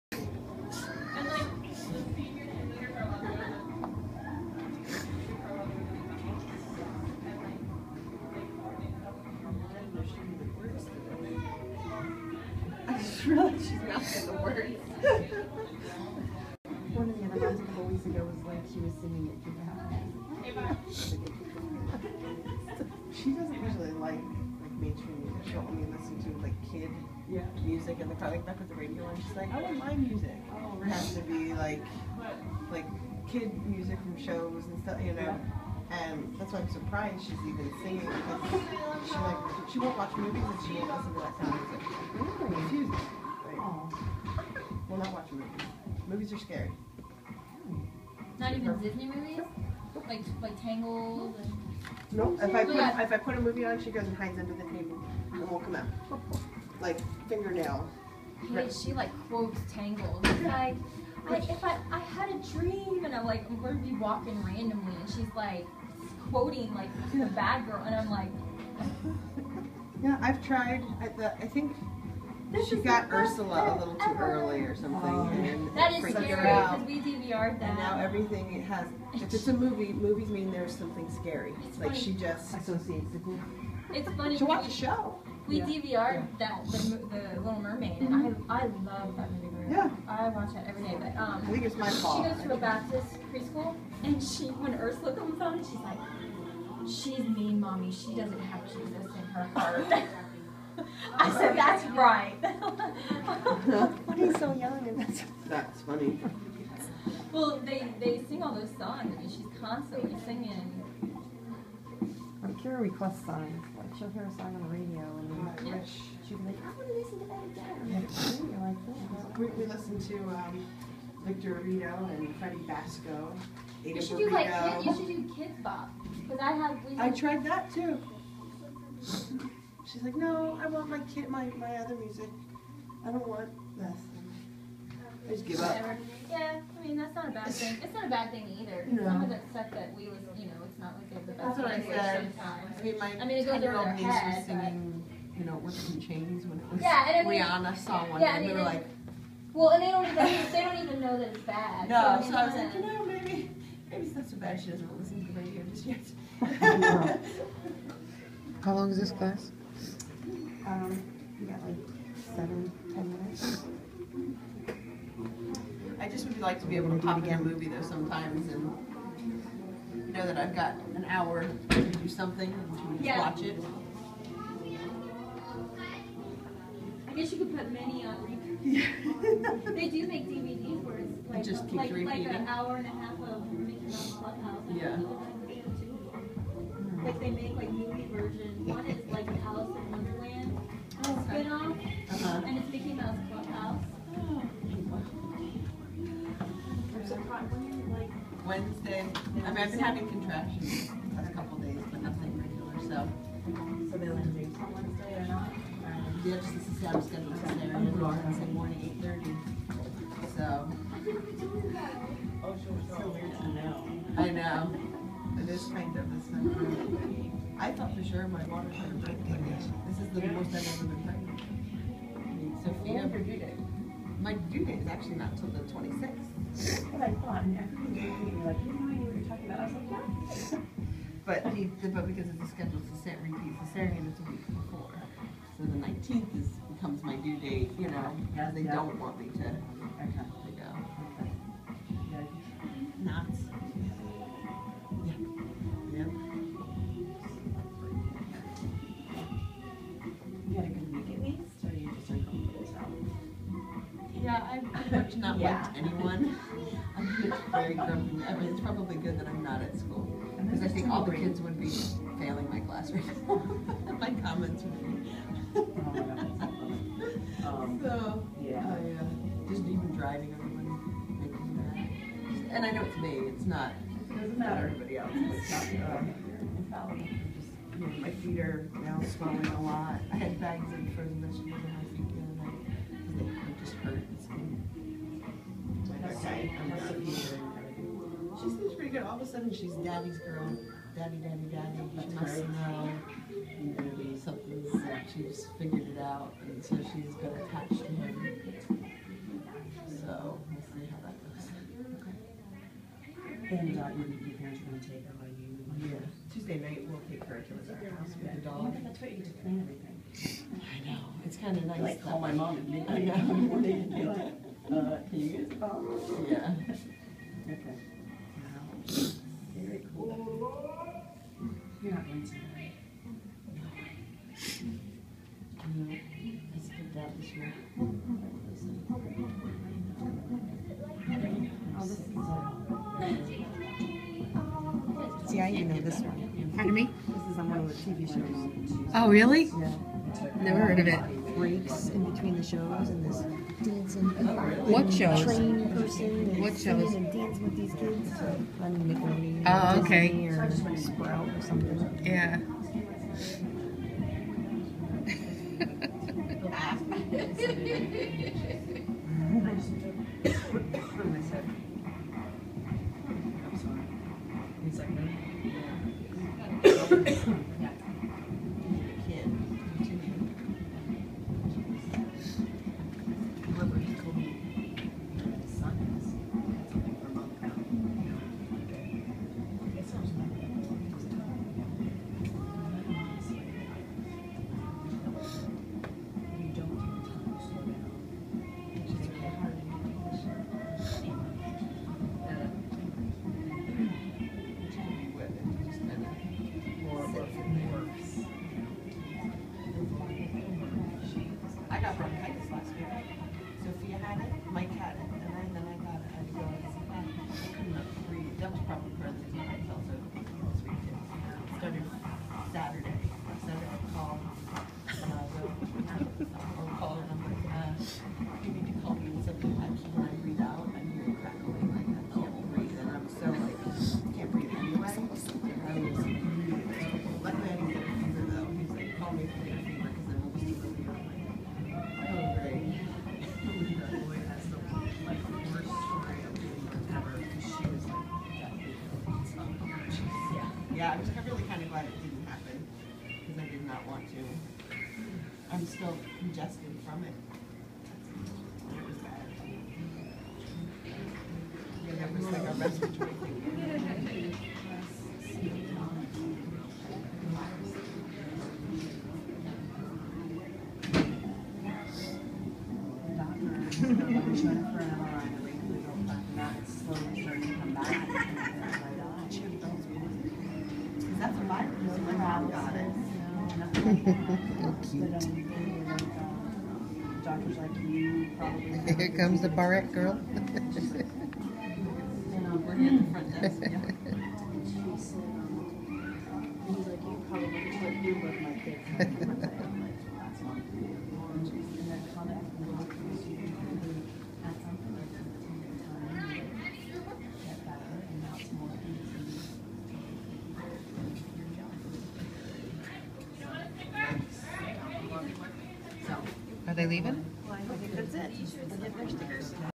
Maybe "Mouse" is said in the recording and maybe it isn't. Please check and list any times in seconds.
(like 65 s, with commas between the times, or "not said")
183 s, 192 s.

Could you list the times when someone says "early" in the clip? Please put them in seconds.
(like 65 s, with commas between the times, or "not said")
74 s.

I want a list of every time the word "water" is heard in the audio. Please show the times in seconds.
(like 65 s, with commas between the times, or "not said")
218 s.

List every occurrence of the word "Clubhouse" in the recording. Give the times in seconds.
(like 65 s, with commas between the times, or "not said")
184 s, 193 s.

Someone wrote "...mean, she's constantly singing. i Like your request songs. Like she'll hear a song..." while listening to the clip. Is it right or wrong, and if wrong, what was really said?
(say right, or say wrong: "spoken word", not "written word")
right.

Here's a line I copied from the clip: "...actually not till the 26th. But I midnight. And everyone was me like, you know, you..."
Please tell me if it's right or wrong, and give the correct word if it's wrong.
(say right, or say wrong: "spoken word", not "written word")
wrong: "thought", not "midnight".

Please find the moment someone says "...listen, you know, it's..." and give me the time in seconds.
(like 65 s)
140 s.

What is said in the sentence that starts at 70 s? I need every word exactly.
I, the, I think this she got Ursula a little too ever.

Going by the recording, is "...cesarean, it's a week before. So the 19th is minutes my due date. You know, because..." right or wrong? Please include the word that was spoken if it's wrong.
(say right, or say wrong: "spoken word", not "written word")
wrong: "becomes", not "minutes".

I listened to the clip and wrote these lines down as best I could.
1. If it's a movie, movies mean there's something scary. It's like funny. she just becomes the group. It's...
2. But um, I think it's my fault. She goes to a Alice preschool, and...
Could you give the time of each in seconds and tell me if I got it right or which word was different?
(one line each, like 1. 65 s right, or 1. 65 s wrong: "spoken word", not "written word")
1. 79 s wrong: "associates", not "becomes"
2. 91 s wrong: "Baptist", not "Alice".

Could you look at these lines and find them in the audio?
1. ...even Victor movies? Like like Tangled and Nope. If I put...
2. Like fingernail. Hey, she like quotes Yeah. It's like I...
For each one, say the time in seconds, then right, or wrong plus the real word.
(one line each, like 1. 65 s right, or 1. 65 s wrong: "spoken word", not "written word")
1. 48 s wrong: "Disney", not "Victor"
2. 56 s wrong: "Tangled", not "Yeah".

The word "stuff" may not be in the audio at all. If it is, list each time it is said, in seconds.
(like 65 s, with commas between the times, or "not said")
34 s, 139 s.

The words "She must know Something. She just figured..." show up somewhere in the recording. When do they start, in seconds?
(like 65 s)
292 s.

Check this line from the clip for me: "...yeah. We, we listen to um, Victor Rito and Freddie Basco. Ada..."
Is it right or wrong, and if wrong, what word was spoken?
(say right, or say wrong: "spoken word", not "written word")
right.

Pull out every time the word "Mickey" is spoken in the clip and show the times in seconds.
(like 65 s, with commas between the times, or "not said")
183 s, 192 s.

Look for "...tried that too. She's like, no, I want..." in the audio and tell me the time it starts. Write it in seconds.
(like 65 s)
127 s.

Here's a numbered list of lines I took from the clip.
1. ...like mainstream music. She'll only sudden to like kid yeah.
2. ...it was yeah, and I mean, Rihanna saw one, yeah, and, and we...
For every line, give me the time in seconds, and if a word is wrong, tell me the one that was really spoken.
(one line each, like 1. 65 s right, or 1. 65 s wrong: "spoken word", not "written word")
1. 24 s wrong: "listen", not "sudden"
2. 146 s right.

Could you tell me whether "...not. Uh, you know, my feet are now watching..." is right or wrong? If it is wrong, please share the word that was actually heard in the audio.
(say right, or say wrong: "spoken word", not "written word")
wrong: "swelling", not "watching".